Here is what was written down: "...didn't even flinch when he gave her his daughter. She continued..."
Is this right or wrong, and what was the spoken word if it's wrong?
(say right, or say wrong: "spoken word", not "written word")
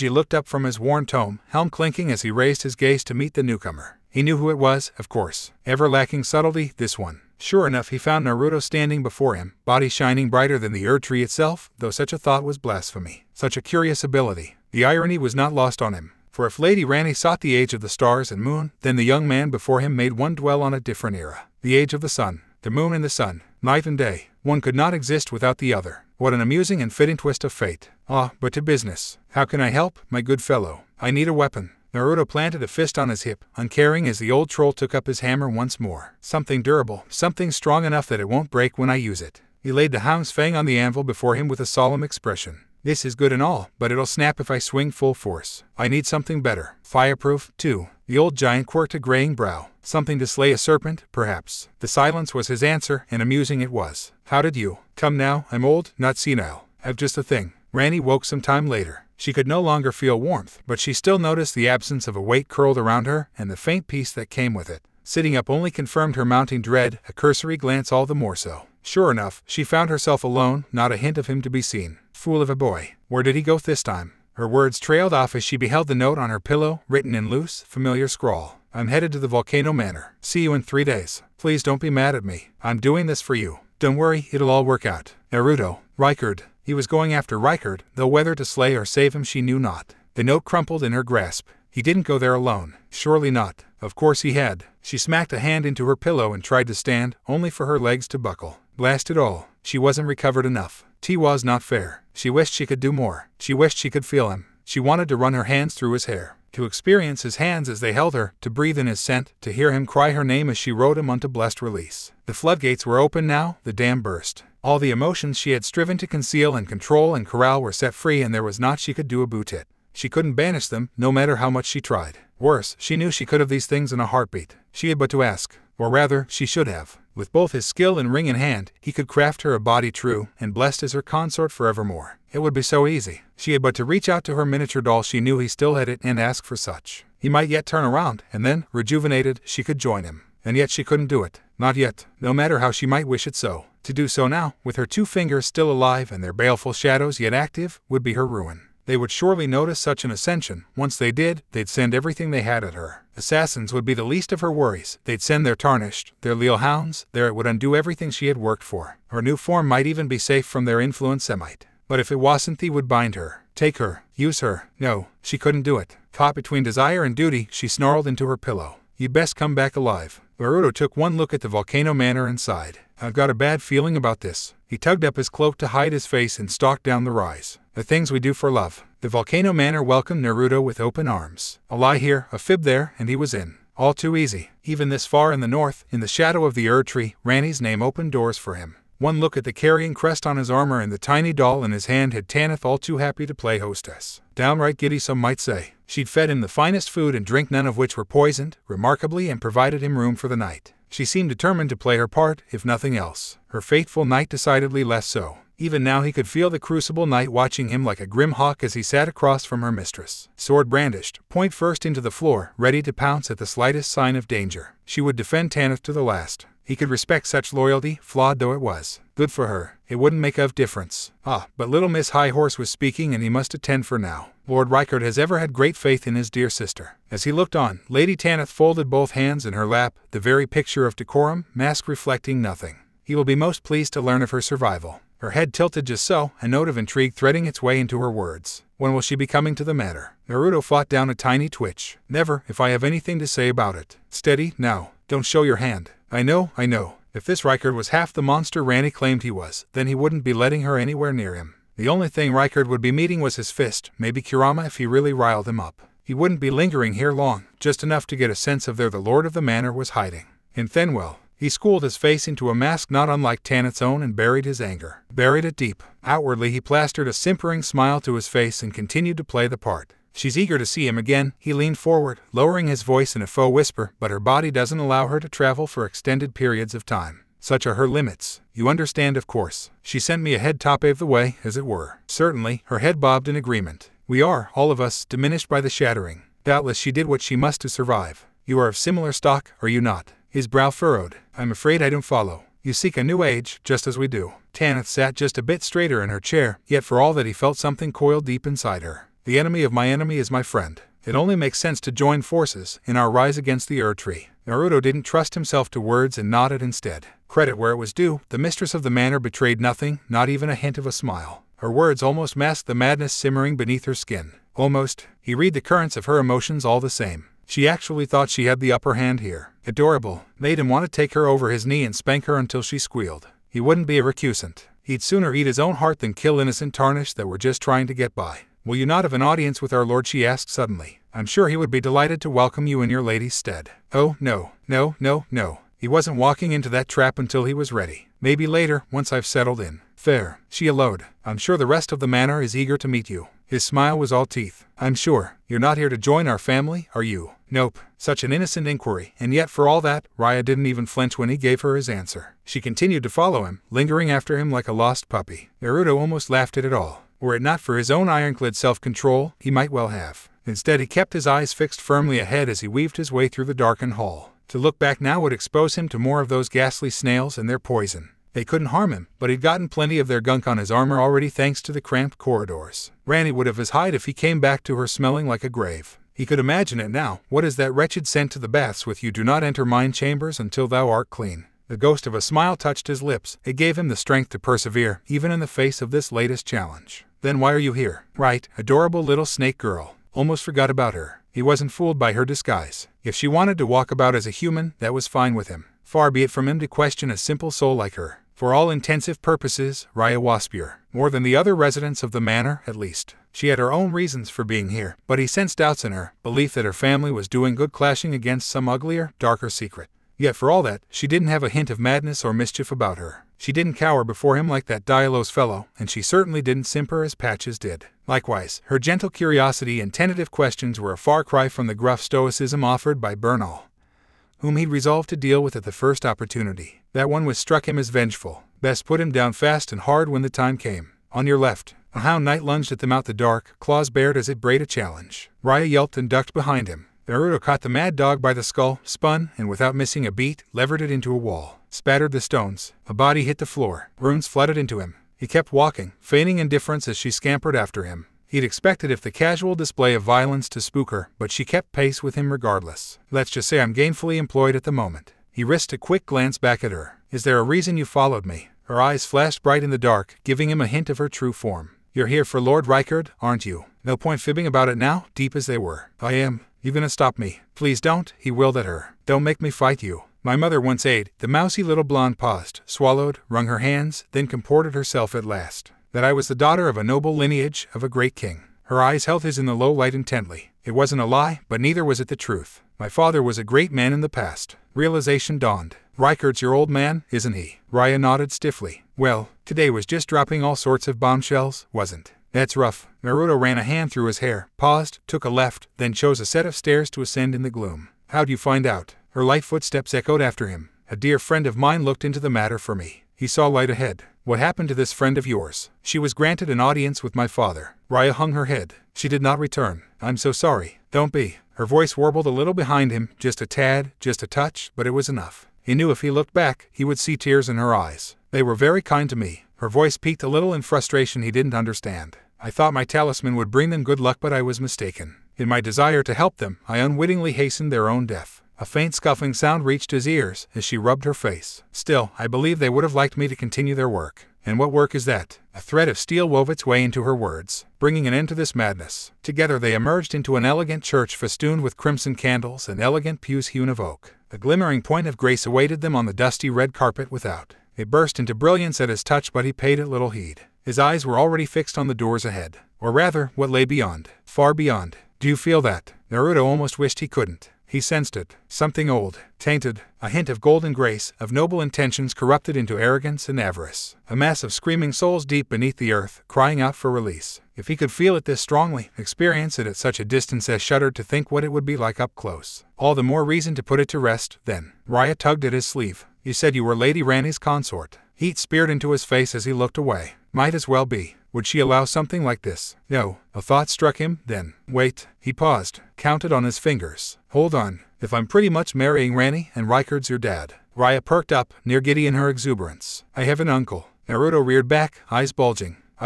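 wrong: "answer", not "daughter".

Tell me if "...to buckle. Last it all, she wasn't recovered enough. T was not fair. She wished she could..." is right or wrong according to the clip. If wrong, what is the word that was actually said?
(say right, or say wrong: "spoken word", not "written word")
right.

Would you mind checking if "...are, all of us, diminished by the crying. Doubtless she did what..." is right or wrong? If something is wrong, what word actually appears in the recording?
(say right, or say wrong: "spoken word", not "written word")
wrong: "shattering", not "crying".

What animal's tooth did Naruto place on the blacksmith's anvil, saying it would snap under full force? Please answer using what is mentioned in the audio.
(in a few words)
Hound's fang.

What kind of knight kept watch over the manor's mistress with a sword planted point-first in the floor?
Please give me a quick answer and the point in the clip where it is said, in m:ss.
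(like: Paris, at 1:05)
Crucible knight, at 3:26.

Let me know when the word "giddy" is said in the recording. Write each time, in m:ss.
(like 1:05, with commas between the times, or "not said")
3:14, 9:51.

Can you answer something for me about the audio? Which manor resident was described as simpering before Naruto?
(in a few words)
Patches.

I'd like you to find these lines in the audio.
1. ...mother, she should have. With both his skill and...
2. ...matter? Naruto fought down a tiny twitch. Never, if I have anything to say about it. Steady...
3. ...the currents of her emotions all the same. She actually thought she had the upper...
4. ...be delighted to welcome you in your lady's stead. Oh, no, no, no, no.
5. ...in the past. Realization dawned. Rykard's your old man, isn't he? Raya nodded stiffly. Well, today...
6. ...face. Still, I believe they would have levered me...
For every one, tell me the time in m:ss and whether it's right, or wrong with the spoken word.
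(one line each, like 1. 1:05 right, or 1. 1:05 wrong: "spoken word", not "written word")
1. 2:05 wrong: "rather", not "mother"
2. 3:59 right
3. 5:15 right
4. 5:31 right
5. 8:03 right
6. 8:51 wrong: "liked", not "levered".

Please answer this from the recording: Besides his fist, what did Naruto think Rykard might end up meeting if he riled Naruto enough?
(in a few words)
Kurama.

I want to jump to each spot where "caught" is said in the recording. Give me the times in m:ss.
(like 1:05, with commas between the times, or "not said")
2:46, 7:17.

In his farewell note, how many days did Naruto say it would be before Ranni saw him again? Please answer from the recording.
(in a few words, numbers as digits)
3.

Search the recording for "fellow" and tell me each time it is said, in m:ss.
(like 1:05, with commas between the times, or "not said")
0:30, 6:55.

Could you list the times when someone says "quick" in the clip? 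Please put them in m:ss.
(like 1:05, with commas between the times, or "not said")
7:35.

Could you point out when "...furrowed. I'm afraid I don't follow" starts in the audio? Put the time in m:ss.
4:50.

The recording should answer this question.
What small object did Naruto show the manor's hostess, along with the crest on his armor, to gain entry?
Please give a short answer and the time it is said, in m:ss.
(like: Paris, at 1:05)
Tiny doll, at 3:10.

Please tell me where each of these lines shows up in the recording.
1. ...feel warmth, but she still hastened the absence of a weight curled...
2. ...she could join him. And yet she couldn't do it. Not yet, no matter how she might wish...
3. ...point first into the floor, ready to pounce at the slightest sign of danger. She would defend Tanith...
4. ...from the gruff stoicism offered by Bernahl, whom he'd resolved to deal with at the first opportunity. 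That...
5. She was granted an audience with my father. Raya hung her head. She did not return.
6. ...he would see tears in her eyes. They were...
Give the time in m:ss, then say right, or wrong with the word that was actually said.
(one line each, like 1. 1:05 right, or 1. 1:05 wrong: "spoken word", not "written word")
1. 0:59 wrong: "noticed", not "hastened"
2. 2:19 right
3. 3:31 right
4. 7:01 right
5. 8:25 right
6. 8:36 right.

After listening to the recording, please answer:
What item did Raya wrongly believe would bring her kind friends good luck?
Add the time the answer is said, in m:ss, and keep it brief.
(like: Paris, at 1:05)
Talisman, at 8:42.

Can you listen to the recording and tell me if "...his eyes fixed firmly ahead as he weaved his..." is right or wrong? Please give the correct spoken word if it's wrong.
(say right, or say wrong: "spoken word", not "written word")
right.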